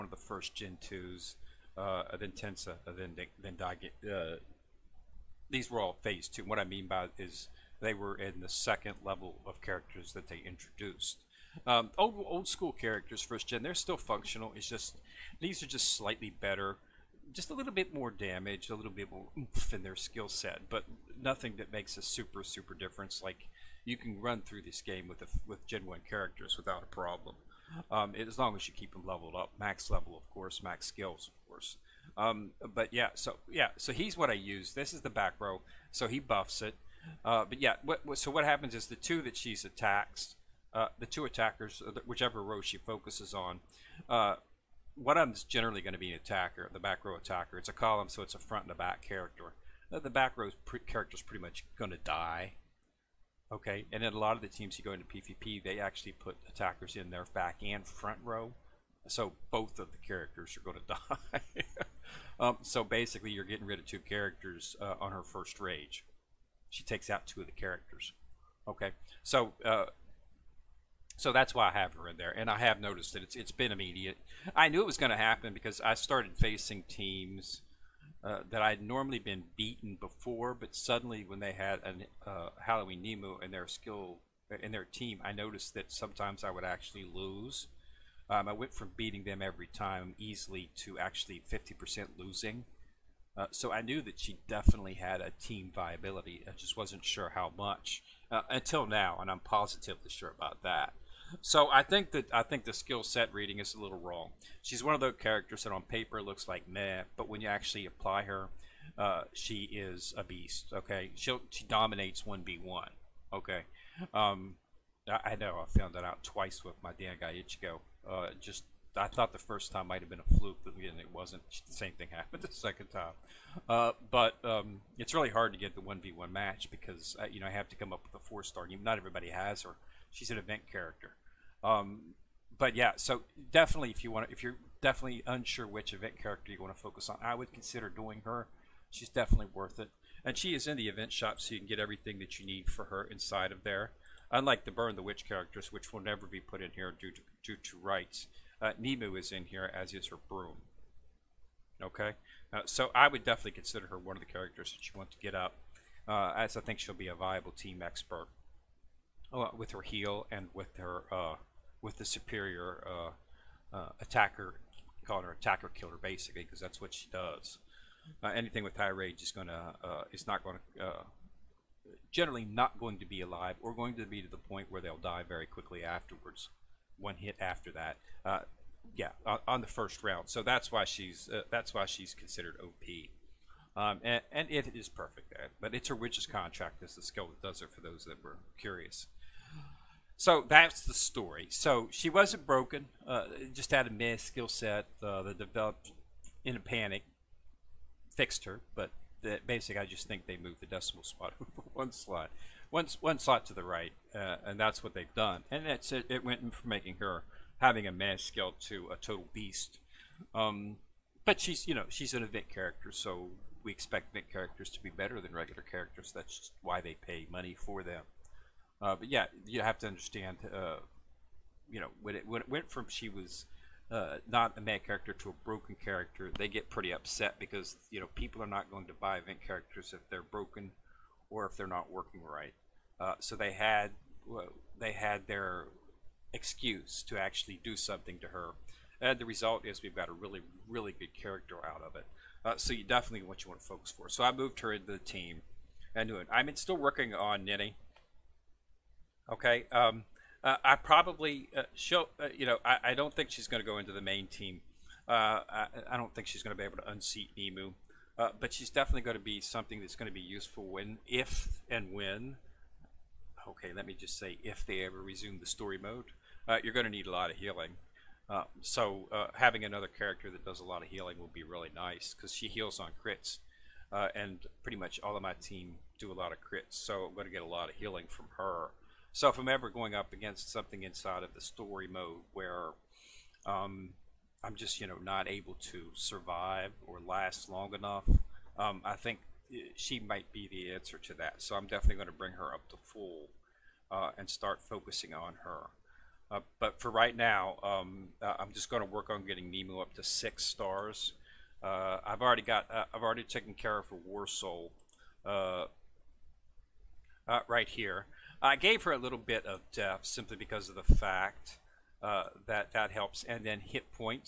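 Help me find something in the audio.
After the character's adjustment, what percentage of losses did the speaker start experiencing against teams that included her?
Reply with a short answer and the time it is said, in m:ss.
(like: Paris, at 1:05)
50%, at 1:31.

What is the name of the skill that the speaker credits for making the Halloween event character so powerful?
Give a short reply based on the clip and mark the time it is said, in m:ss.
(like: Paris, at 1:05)
Witch's Contract, at 3:05.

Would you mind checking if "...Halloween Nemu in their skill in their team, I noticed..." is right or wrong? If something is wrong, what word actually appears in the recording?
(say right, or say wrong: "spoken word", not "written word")
right.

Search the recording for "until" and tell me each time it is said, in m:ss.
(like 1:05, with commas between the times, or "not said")
1:38.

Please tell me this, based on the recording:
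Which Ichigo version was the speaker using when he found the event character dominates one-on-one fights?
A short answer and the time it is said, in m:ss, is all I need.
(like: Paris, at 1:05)
Dangai Ichigo, at 1:56.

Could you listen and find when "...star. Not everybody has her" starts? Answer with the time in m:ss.
2:08.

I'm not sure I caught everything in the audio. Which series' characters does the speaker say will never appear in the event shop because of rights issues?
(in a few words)
Burn the Witch.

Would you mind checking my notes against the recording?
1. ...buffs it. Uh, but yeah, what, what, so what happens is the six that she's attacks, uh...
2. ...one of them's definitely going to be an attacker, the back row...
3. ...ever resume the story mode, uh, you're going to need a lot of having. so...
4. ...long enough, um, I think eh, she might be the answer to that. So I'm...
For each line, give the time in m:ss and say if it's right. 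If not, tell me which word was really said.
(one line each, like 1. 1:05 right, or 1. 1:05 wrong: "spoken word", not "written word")
1. 0:36 wrong: "two", not "six"
2. 0:44 wrong: "generally", not "definitely"
3. 4:24 wrong: "healing", not "having"
4. 4:47 right.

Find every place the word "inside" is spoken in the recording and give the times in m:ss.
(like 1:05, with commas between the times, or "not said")
2:23, 4:40.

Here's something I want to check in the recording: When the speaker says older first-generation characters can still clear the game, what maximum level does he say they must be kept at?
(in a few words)
30.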